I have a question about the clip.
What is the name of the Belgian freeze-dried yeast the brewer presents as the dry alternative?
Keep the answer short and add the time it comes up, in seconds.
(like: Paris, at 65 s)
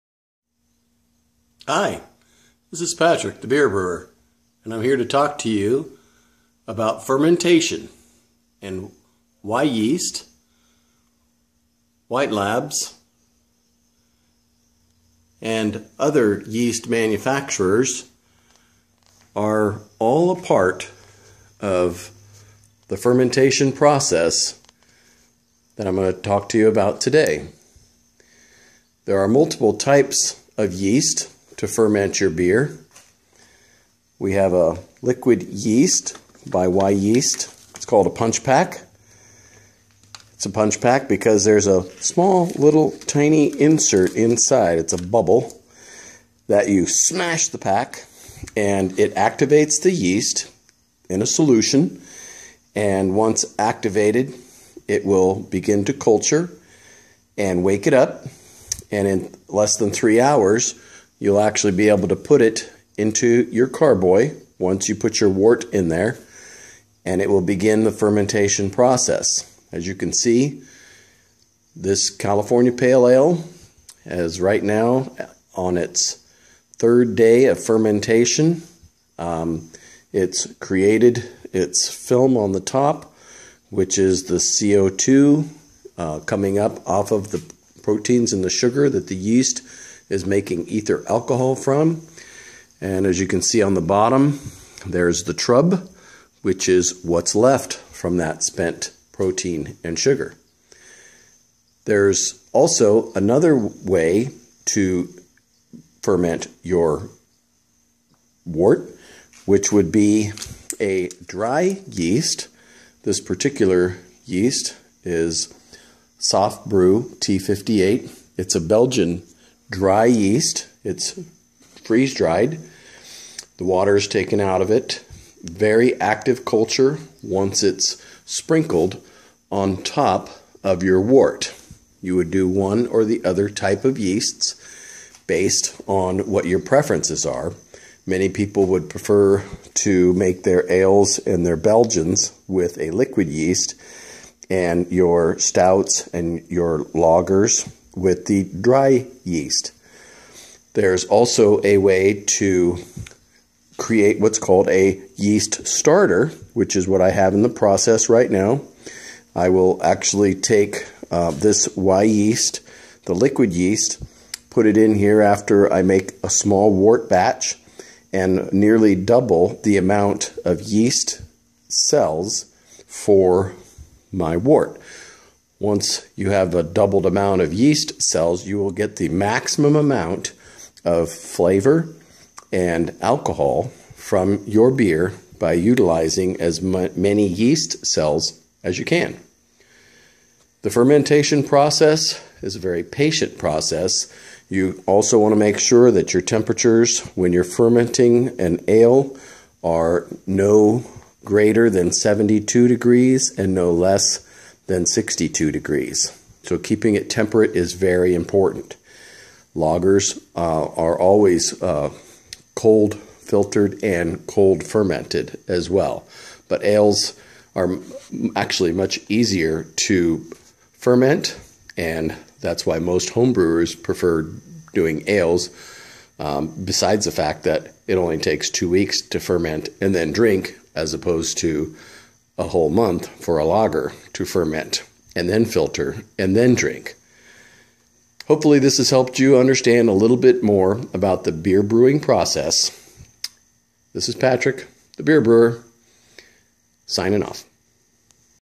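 Soft Brew T58, at 116 s.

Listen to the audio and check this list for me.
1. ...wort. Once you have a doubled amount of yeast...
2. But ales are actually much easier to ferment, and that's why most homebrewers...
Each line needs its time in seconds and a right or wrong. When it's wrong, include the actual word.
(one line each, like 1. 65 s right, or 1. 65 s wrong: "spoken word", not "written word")
1. 174 s right
2. 216 s right.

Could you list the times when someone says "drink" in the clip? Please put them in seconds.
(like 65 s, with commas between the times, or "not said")
230 s, 236 s.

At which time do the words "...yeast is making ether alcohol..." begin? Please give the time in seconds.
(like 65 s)
89 s.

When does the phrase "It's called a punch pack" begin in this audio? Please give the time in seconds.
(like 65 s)
37 s.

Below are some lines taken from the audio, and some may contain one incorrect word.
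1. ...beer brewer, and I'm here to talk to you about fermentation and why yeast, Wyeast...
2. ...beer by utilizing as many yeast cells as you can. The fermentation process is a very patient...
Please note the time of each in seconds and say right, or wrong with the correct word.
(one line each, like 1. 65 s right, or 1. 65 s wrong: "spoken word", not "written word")
1. 3 s wrong: "White", not "Wyeast"
2. 184 s right.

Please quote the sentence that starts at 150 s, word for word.
There's also a way to create what's called a yeast starter, which is what I have in the process right now.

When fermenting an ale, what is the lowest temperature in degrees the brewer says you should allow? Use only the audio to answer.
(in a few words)
62 degrees.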